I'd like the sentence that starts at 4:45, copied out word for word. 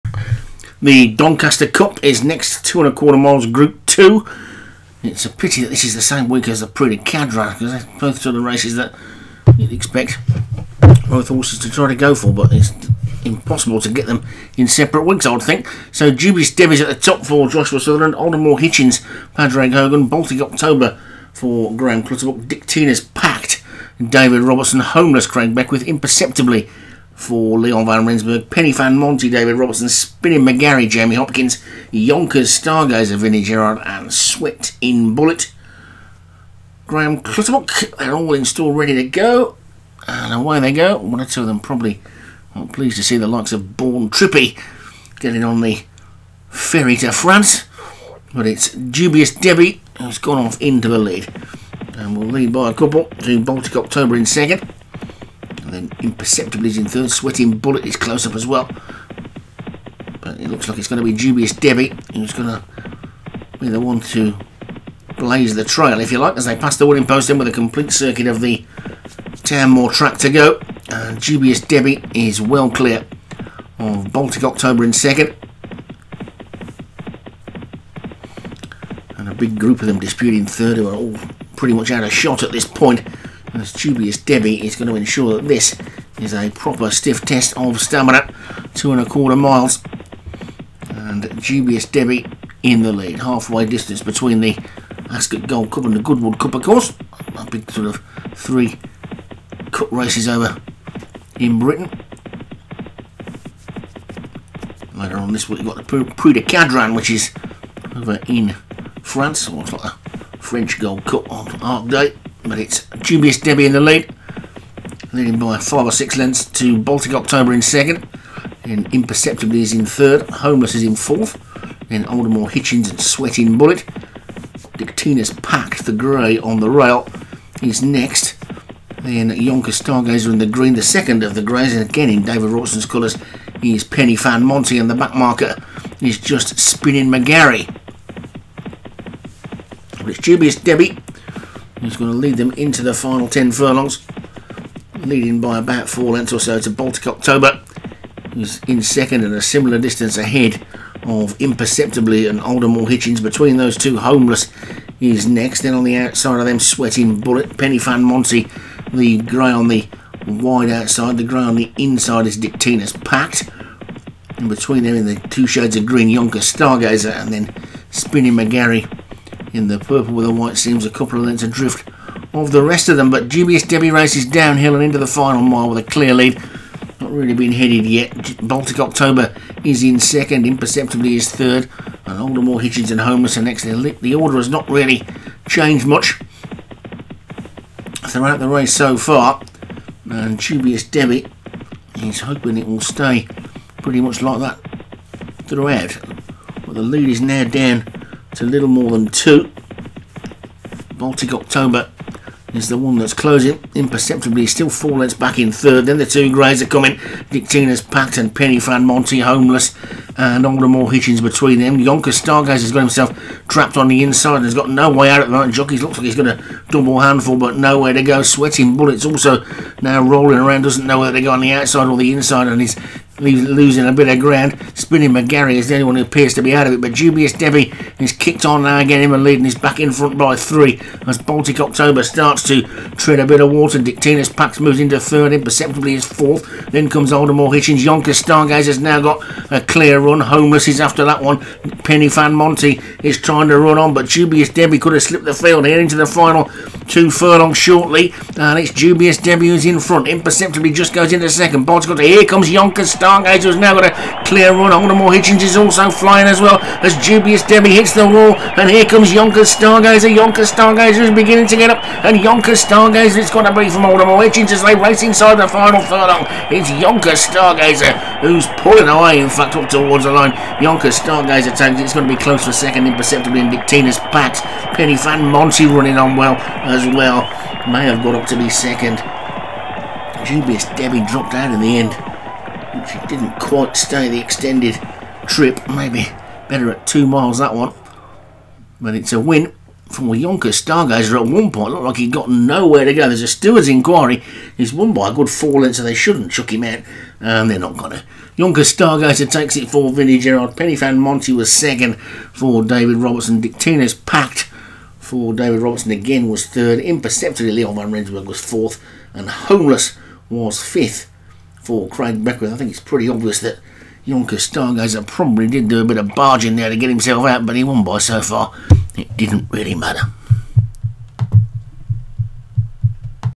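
Maybe better at two miles that one.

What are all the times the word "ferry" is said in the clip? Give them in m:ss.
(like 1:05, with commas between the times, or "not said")
0:46.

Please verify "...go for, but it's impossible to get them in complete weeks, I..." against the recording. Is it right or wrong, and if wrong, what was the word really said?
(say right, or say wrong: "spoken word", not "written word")
wrong: "separate", not "complete".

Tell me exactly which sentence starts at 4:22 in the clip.
Stargazer, it's going to be from more Hitchens as they race inside the final furlong.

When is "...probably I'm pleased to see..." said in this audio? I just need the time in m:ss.
0:41.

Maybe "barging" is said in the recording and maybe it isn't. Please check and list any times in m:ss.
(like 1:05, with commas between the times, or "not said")
5:16.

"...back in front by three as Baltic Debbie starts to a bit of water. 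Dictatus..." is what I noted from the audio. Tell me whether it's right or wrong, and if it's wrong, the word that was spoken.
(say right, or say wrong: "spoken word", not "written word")
wrong: "October", not "Debbie".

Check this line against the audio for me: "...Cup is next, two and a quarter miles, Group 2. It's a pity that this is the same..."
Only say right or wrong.
right.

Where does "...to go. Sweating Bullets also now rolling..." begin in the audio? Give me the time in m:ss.
3:37.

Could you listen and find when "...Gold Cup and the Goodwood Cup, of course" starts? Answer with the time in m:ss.
1:35.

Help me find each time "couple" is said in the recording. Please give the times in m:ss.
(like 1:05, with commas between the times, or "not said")
0:52, 2:50.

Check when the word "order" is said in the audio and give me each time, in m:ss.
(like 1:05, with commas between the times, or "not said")
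3:04.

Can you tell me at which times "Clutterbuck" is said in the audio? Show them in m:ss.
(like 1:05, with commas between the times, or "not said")
0:22, 0:37.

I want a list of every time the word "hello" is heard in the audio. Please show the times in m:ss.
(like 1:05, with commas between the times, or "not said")
not said.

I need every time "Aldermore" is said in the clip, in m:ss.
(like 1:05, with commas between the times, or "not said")
0:18, 2:02, 2:32, 3:02, 3:30, 3:57, 4:14.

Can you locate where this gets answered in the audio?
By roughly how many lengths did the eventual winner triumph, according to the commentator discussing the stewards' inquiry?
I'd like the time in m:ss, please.
4:54.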